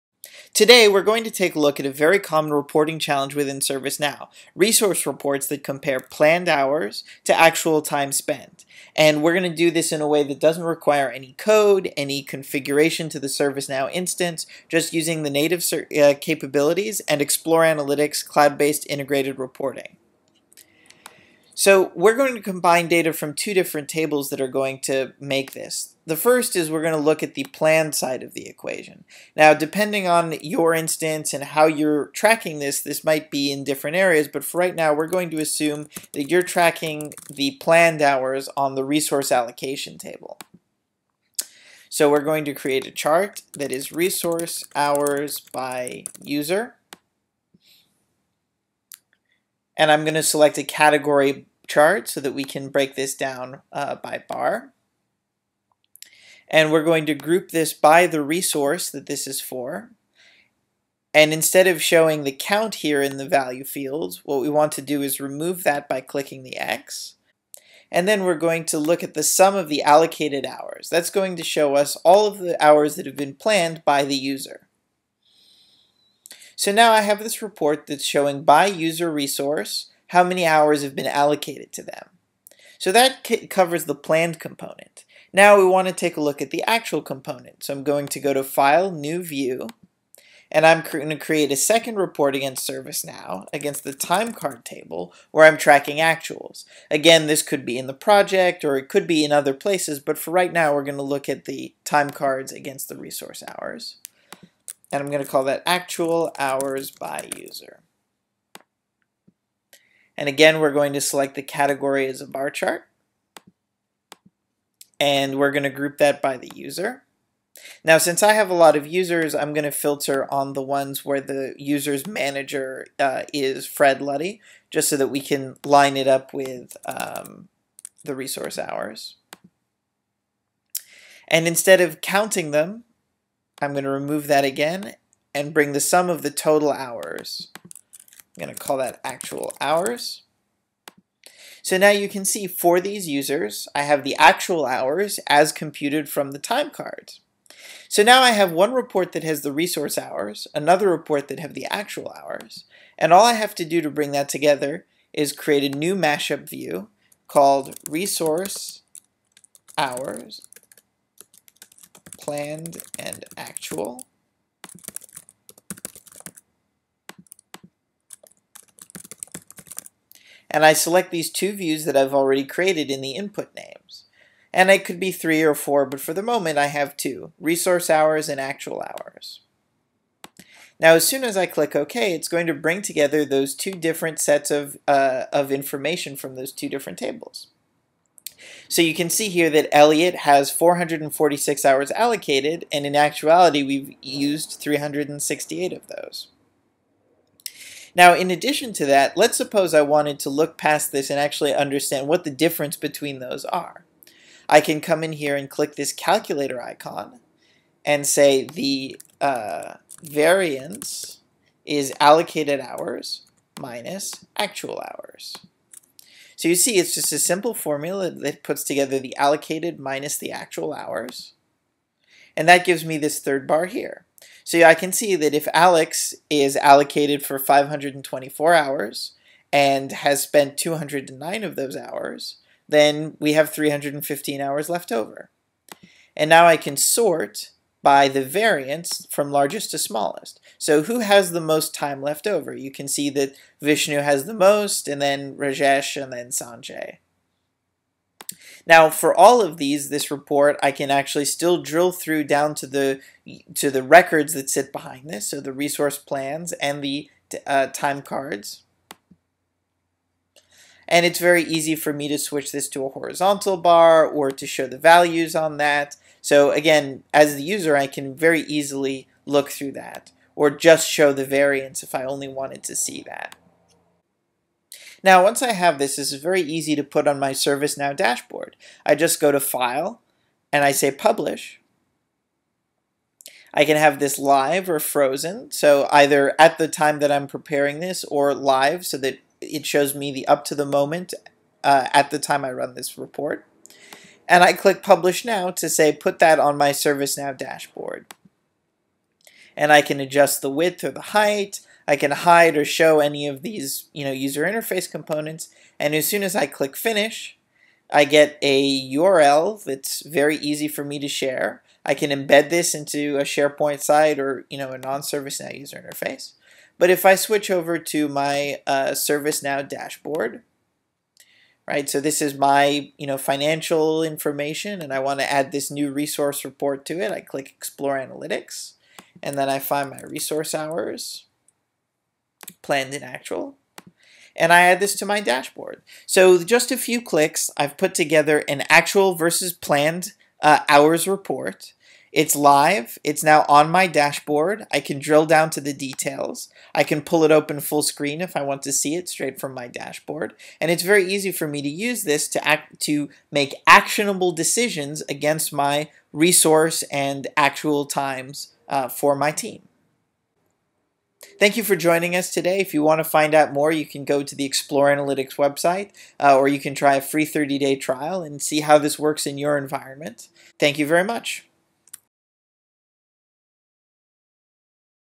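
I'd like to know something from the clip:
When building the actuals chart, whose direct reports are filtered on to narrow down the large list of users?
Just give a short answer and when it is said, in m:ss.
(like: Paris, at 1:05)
Fred Luddy, at 2:03.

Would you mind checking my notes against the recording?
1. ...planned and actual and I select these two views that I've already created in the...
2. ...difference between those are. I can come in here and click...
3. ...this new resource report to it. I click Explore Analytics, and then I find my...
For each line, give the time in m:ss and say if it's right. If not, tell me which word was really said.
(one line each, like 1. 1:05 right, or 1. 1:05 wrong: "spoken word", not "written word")
1. 2:42 right
2. 3:22 right
3. 5:25 right.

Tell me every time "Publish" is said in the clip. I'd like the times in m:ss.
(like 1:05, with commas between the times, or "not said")
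4:40, 4:54.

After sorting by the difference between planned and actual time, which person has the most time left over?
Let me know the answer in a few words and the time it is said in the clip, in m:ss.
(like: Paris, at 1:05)
Vishnu, at 4:03.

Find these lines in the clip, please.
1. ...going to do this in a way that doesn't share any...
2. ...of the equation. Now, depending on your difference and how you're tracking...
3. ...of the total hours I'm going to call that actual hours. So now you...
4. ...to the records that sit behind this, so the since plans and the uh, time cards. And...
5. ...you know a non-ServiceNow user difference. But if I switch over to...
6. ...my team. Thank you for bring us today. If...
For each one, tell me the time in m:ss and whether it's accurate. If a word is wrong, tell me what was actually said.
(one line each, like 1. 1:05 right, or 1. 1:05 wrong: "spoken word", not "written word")
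1. 0:09 wrong: "require", not "share"
2. 0:28 wrong: "instance", not "difference"
3. 2:16 right
4. 4:13 wrong: "resource", not "since"
5. 5:14 wrong: "interface", not "difference"
6. 5:59 wrong: "joining", not "bring".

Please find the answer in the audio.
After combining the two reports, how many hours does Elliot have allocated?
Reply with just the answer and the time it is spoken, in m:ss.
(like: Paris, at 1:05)
446, at 3:10.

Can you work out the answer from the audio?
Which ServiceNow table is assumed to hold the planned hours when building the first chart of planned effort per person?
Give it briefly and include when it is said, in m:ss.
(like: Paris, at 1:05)
Resource allocation table, at 0:38.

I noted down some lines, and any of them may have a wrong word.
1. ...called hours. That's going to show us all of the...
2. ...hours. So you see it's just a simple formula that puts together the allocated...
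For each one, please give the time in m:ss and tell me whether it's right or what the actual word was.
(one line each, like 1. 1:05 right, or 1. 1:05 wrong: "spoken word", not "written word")
1. 1:09 wrong: "allocated", not "called"
2. 3:34 right.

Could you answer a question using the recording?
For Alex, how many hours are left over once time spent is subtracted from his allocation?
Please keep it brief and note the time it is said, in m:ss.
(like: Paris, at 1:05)
315, at 3:53.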